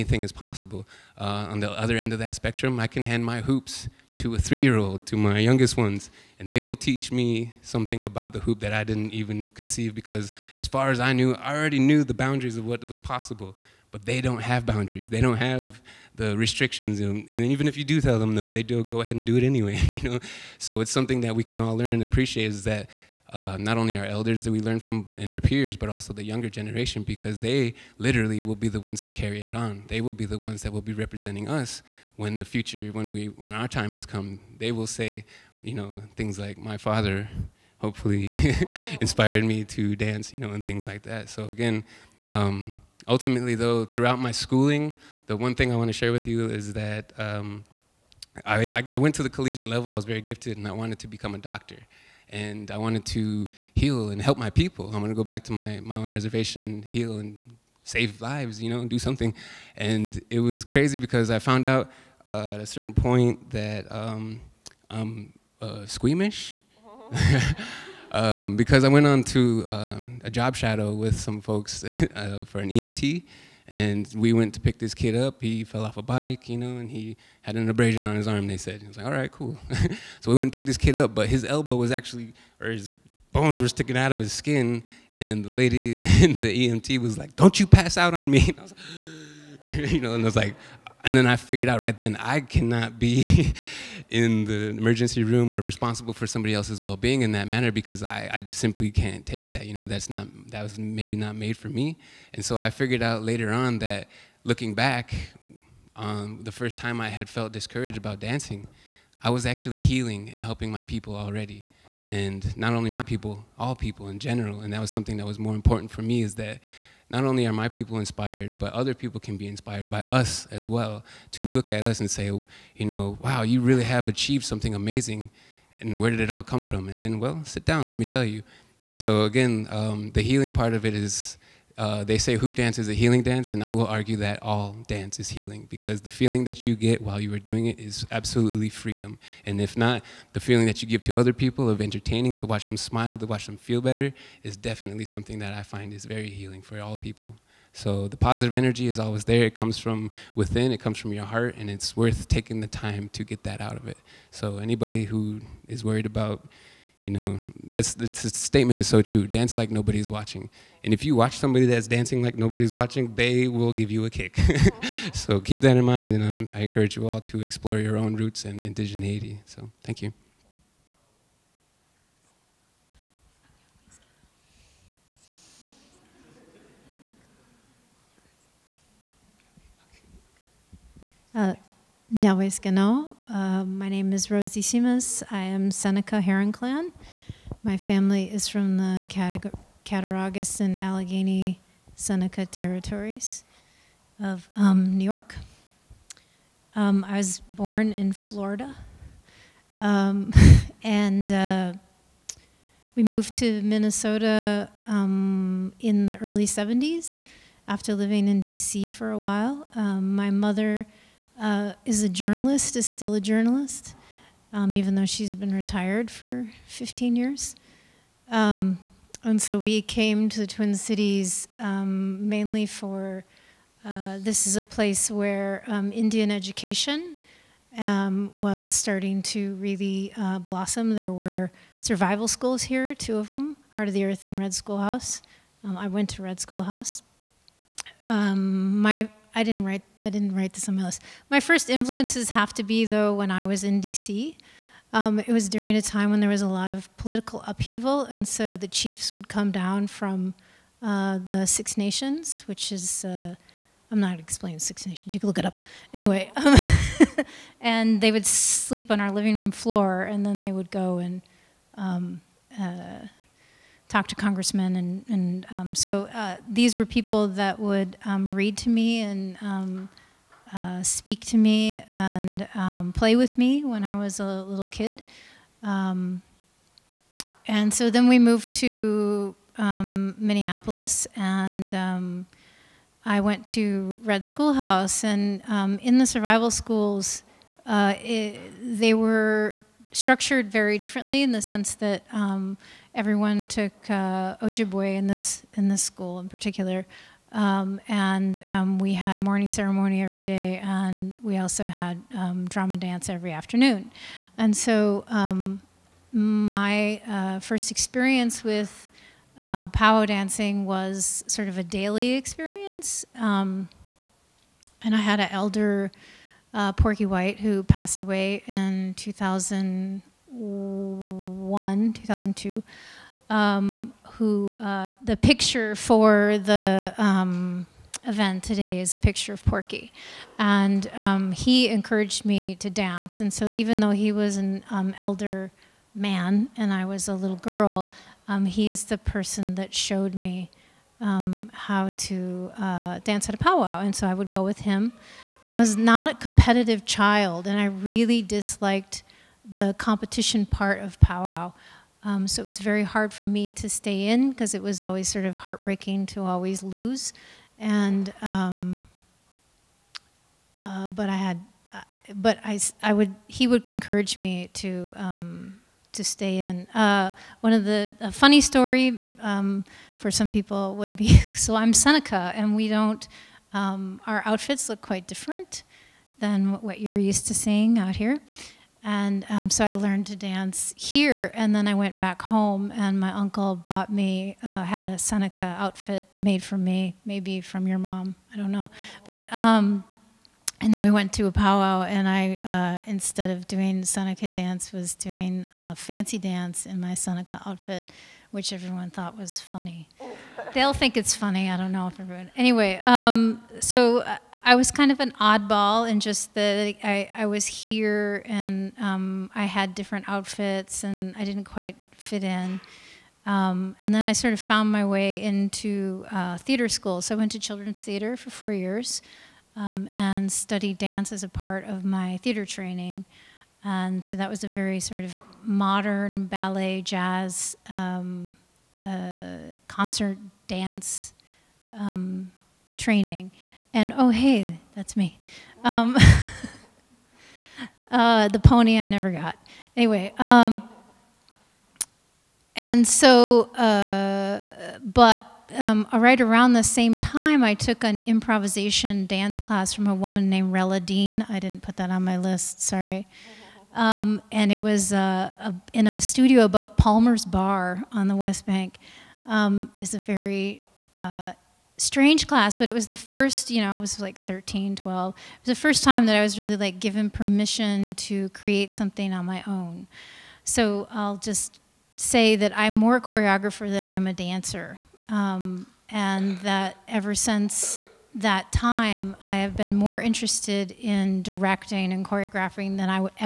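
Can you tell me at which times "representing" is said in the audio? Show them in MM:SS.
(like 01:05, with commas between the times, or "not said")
00:30.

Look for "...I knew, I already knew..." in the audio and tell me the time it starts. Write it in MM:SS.
00:11.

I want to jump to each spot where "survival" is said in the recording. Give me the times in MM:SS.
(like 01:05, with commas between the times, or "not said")
03:51, 04:46.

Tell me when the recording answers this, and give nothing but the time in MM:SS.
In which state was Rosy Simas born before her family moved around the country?
03:18.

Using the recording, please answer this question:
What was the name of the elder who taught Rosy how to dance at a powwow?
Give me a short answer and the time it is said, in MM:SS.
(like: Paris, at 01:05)
Porky White, at 05:16.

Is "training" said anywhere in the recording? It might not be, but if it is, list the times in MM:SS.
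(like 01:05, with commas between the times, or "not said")
07:02, 07:12.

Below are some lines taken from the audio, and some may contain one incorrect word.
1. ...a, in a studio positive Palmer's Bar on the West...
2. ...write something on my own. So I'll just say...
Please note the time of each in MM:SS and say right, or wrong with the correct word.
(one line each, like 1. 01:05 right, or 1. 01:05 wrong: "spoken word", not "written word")
1. 07:35 wrong: "above", not "positive"
2. 07:48 wrong: "create", not "write".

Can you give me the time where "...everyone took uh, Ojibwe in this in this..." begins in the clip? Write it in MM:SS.
04:52.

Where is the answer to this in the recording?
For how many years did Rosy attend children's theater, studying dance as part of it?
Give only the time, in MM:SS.
06:58.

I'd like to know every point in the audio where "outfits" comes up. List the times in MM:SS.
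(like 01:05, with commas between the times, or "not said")
06:14, 06:25, 06:37, 06:50.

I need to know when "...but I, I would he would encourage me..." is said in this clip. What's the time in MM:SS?
06:02.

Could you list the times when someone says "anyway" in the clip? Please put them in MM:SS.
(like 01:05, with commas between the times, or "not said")
00:19, 04:15, 06:42, 07:19.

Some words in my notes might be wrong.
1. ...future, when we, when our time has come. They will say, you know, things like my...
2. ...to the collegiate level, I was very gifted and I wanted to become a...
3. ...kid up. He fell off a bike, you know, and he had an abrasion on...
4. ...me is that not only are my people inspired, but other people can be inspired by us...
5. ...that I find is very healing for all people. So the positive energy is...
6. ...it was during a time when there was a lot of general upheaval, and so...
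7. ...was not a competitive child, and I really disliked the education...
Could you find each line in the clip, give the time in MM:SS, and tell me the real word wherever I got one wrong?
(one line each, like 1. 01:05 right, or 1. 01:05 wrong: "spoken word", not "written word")
1. 00:32 right
2. 00:49 right
3. 01:14 right
4. 01:56 right
5. 02:25 right
6. 04:05 wrong: "political", not "general"
7. 05:45 wrong: "competition", not "education".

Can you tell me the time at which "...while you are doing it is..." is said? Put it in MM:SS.
02:17.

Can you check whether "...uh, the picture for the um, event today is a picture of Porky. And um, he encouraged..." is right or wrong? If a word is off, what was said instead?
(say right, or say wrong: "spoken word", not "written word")
right.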